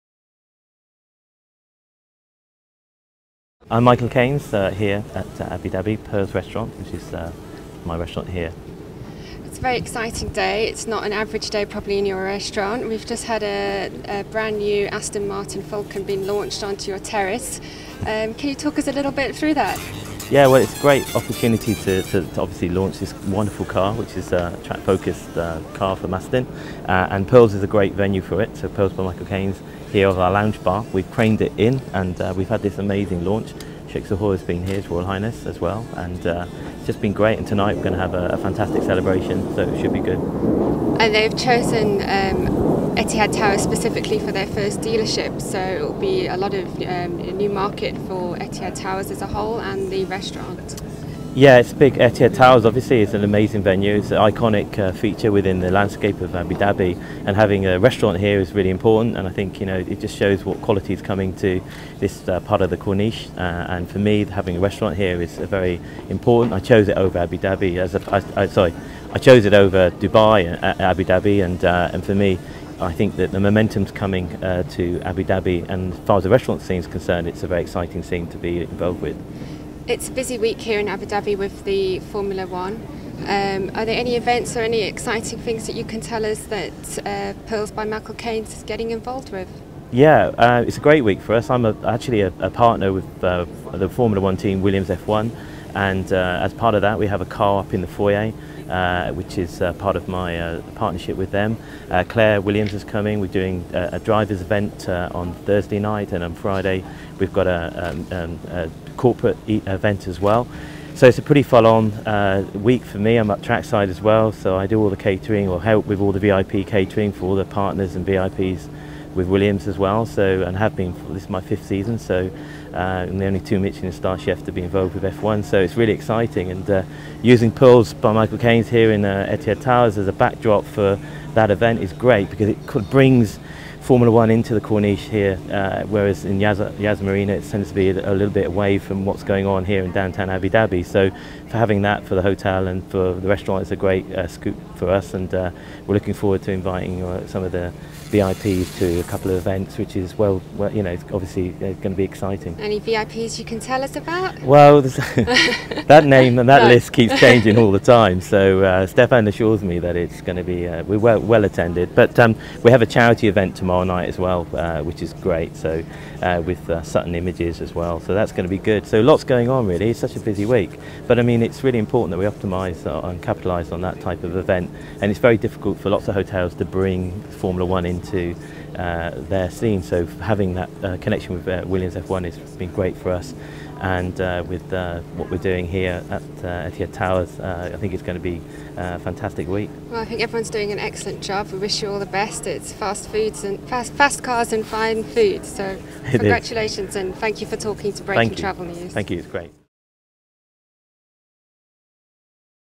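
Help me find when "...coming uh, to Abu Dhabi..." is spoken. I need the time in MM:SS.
01:13.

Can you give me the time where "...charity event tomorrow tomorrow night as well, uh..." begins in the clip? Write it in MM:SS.
02:42.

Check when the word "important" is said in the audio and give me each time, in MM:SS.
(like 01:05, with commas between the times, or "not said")
00:58, 01:06, 02:51.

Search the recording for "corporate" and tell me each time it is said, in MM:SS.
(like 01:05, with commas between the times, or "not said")
01:48.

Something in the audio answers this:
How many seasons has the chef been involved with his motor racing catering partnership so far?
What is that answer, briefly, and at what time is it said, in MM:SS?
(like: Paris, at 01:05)
5, at 02:01.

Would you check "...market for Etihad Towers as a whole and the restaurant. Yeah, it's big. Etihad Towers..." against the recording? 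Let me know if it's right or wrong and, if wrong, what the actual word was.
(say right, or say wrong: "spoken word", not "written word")
right.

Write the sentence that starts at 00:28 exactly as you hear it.
So Pearls by Michael here here is our lounge bar.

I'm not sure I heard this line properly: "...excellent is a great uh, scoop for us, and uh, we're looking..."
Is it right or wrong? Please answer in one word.
wrong.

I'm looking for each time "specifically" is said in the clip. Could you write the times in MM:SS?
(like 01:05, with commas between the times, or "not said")
00:43.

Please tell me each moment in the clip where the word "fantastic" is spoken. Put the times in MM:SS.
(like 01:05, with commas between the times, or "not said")
00:38, 03:08.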